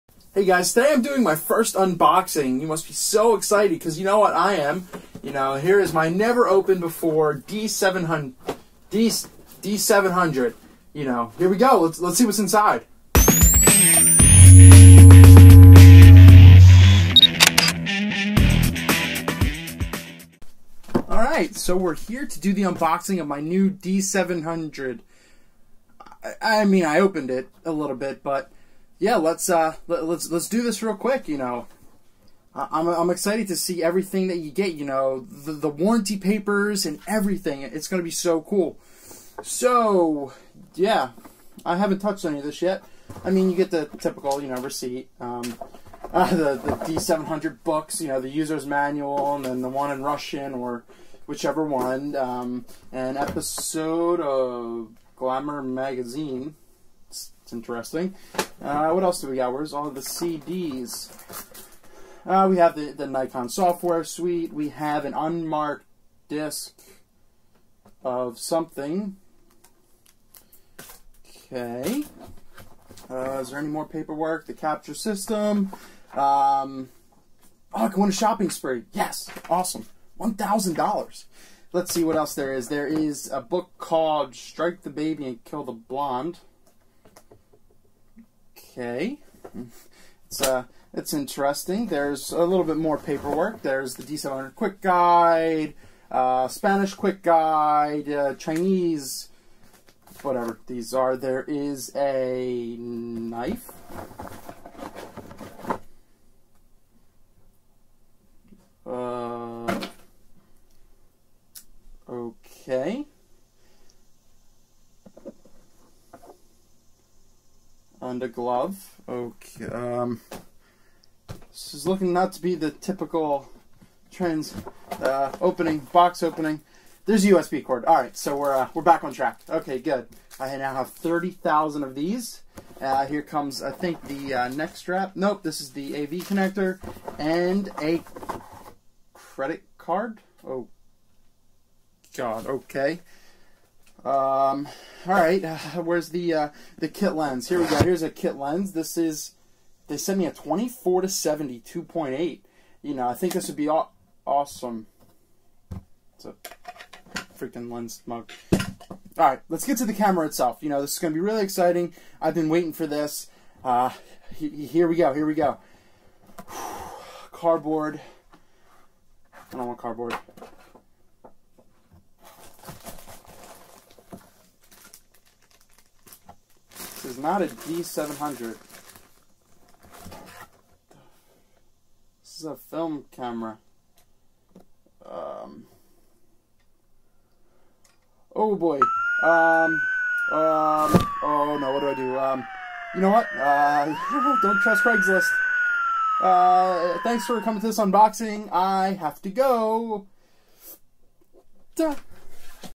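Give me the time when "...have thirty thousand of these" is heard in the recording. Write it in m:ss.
2:10.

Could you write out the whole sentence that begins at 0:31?
You know, I'm, I'm excited to see everything that you get, you know, the, the warranty papers and everything.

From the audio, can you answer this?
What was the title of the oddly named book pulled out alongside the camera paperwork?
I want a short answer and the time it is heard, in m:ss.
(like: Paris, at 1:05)
Strike the Baby and Kill the Blonde, at 1:24.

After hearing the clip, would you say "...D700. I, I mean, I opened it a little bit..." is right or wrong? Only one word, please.
right.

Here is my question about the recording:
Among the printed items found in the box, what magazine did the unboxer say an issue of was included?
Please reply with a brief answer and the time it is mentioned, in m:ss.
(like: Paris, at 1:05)
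Glamour Magazine, at 0:55.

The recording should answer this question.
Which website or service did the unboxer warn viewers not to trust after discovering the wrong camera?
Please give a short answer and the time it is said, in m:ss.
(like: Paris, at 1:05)
Craigslist, at 3:14.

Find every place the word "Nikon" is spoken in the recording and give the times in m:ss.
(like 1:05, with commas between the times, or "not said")
1:03.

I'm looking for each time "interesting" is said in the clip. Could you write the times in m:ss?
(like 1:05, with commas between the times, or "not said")
0:57, 1:31.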